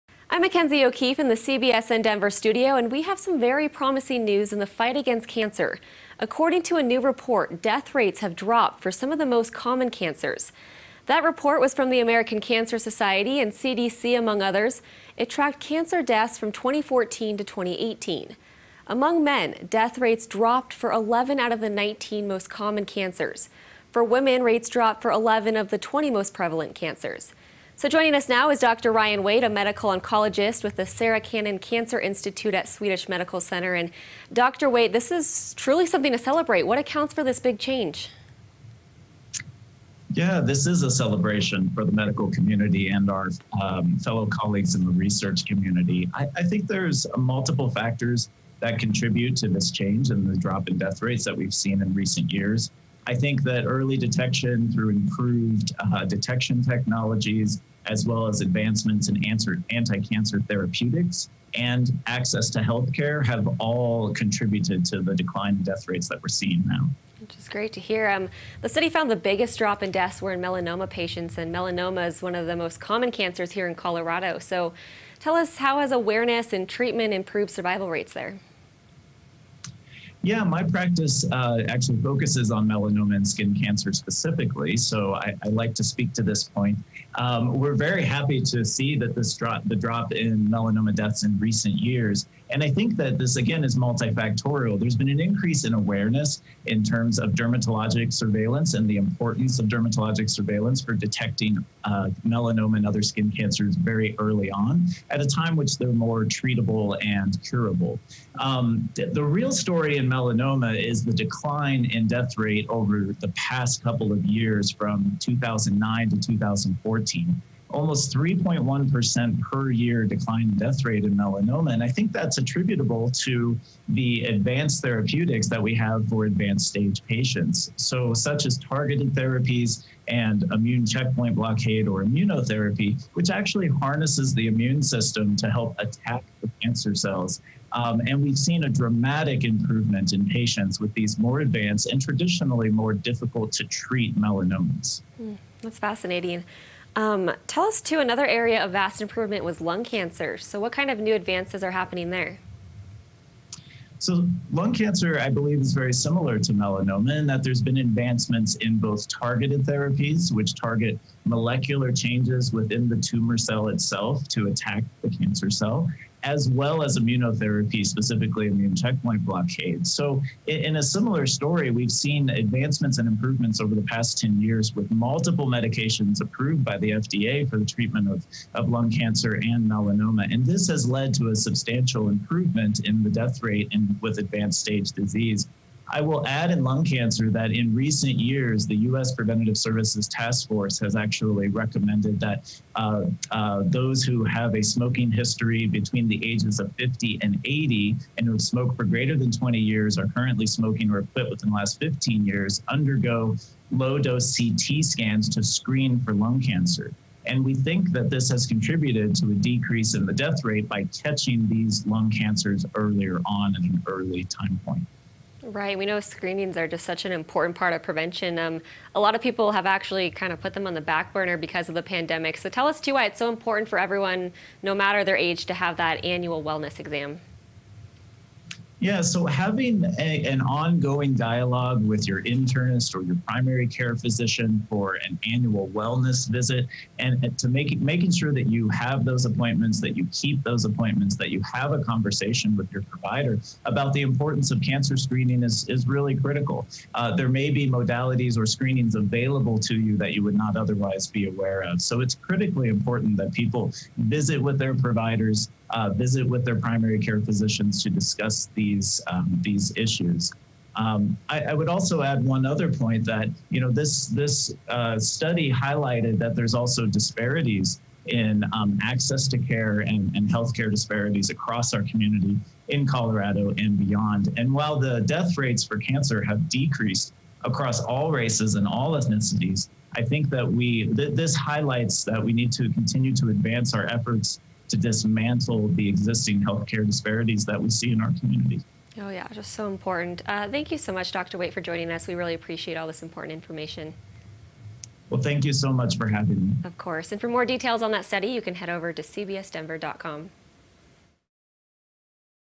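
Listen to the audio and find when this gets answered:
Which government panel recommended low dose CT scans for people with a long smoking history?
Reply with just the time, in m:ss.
3:08.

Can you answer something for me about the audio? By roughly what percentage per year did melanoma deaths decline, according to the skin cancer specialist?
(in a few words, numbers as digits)
3.1%.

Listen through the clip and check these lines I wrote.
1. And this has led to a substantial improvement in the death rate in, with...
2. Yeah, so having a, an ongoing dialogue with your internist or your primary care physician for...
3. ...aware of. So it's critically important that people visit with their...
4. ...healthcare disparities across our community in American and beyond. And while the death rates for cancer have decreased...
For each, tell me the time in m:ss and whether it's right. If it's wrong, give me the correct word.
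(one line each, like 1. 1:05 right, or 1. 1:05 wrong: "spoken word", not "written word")
1. 3:00 right
2. 3:48 right
3. 4:11 right
4. 4:30 wrong: "Colorado", not "American".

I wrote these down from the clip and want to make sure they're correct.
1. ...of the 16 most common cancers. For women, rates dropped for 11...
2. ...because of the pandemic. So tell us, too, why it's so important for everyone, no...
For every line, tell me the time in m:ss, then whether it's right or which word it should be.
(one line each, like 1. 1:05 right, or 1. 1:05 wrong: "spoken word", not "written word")
1. 0:21 wrong: "19", not "16"
2. 3:41 right.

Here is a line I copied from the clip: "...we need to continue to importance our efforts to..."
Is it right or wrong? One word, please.
wrong.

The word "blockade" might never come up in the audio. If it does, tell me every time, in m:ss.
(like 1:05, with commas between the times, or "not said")
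2:11, 2:49.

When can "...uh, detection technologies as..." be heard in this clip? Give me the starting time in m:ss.
0:55.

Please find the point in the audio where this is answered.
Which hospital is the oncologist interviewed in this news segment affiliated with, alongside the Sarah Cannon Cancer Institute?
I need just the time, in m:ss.
0:32.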